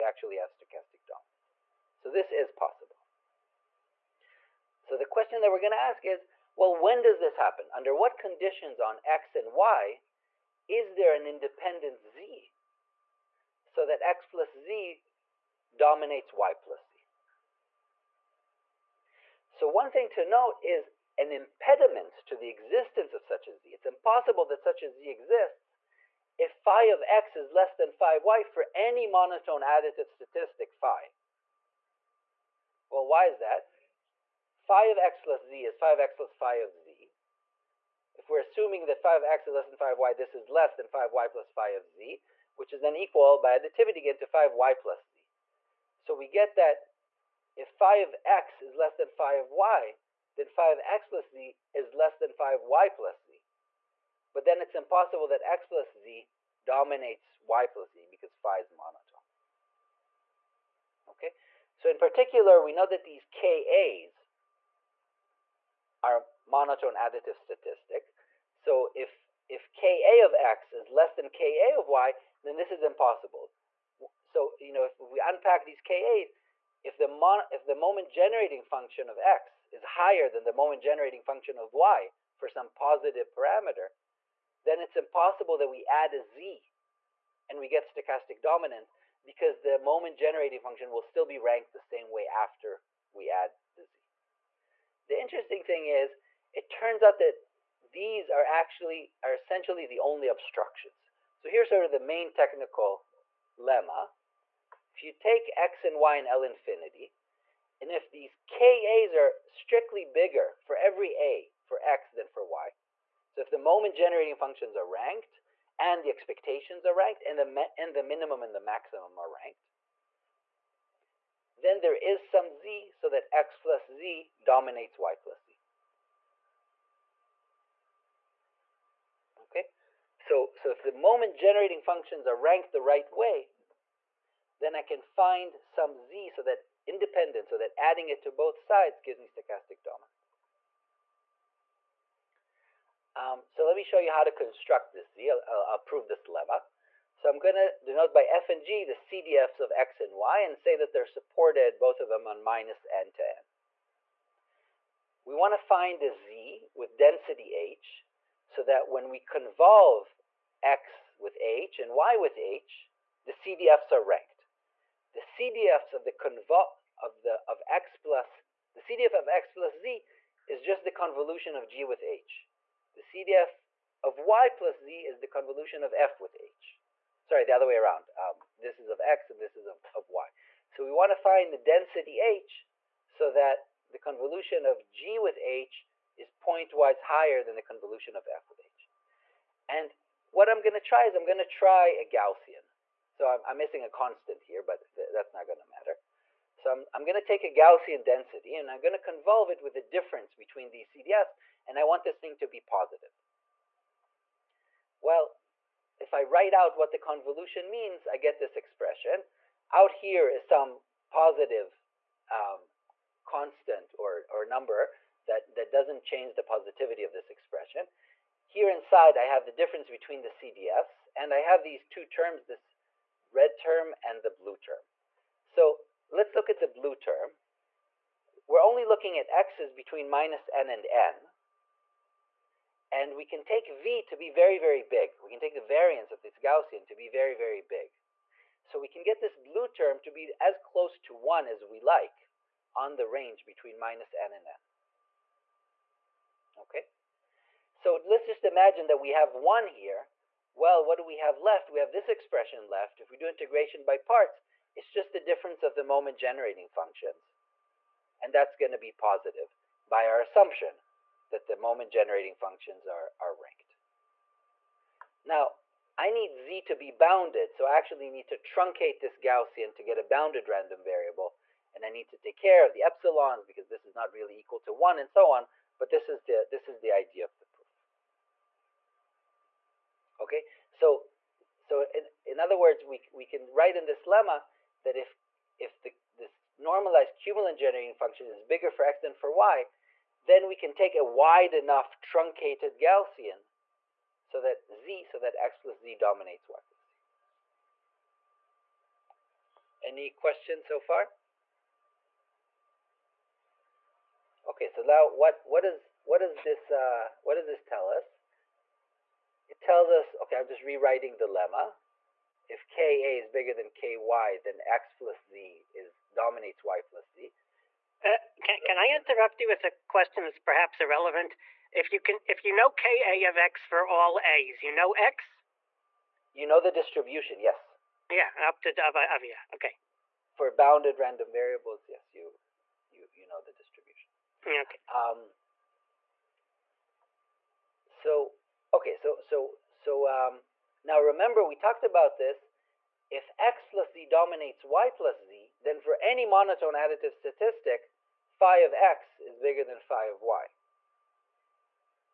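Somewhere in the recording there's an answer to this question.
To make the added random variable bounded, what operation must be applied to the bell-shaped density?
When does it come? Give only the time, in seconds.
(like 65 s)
268 s.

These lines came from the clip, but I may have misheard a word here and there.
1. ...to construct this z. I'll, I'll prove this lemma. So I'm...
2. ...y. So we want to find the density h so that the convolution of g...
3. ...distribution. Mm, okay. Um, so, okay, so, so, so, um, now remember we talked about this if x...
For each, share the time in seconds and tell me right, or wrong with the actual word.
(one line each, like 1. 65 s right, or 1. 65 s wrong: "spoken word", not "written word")
1. 144 s right
2. 180 s right
3. 333 s right.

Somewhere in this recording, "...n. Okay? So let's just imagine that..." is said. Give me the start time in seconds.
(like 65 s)
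244 s.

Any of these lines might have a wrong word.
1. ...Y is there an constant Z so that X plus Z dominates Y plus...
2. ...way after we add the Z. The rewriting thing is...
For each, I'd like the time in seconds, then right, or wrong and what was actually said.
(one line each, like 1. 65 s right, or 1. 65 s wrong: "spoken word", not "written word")
1. 9 s wrong: "independent", not "constant"
2. 92 s wrong: "interesting", not "rewriting".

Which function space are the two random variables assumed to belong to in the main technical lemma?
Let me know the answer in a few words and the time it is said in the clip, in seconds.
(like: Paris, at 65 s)
L infinity, at 106 s.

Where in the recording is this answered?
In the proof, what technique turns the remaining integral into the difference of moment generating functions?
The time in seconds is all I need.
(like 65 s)
253 s.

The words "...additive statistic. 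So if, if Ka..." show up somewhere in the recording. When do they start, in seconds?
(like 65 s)
66 s.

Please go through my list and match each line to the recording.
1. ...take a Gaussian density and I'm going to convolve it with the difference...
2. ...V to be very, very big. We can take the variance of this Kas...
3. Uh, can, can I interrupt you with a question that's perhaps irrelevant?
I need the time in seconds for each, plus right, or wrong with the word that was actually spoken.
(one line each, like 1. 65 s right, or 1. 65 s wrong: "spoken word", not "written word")
1. 197 s right
2. 233 s wrong: "Gaussian", not "Kas"
3. 318 s right.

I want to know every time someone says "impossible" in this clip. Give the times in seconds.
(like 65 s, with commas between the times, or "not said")
23 s, 54 s, 72 s, 84 s.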